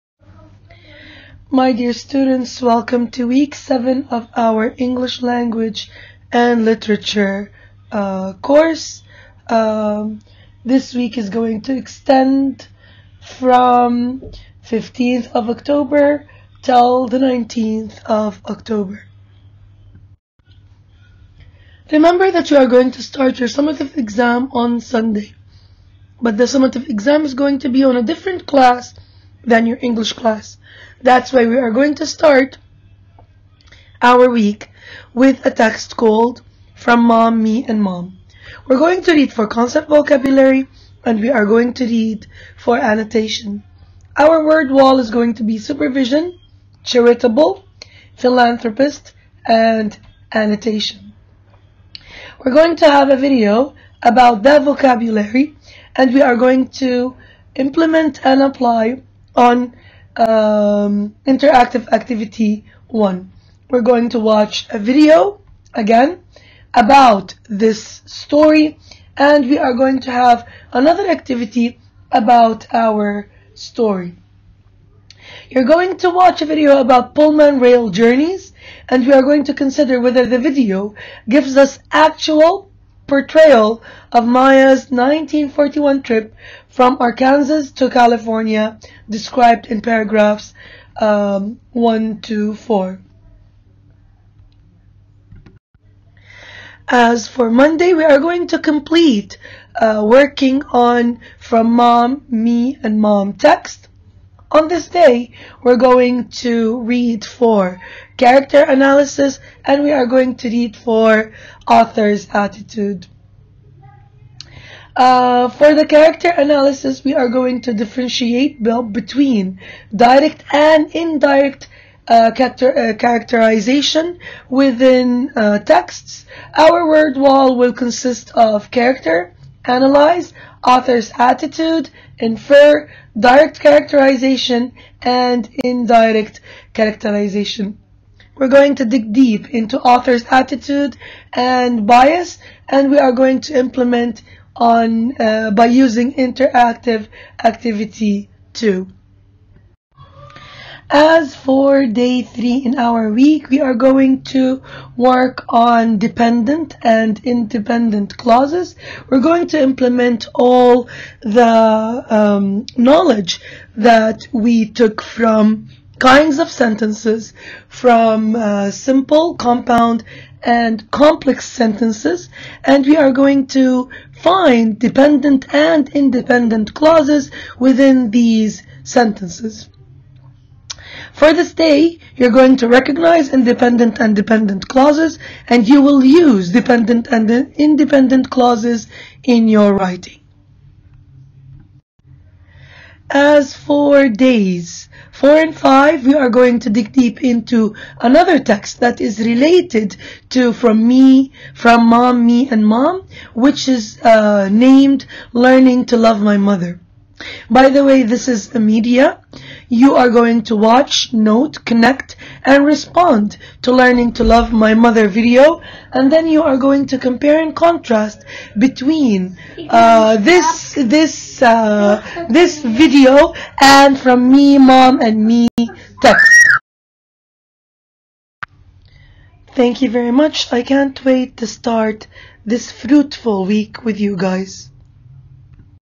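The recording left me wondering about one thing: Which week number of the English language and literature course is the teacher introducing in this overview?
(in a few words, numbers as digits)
7.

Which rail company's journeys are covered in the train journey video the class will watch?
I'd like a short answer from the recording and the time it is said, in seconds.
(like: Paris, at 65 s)
Pullman, at 77 s.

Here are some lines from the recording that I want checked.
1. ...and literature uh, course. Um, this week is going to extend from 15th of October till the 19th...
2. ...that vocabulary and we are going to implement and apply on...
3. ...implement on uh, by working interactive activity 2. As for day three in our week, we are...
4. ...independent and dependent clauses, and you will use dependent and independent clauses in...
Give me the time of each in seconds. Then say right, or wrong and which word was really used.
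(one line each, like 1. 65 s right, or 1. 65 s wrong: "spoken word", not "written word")
1. 6 s right
2. 54 s right
3. 143 s wrong: "using", not "working"
4. 183 s right.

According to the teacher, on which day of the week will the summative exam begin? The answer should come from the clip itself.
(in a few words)
Sunday.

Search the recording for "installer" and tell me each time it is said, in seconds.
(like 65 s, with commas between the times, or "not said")
not said.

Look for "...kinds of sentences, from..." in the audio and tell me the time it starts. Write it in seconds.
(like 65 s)
165 s.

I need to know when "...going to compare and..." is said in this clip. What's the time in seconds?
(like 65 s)
216 s.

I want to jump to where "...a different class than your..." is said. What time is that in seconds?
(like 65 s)
27 s.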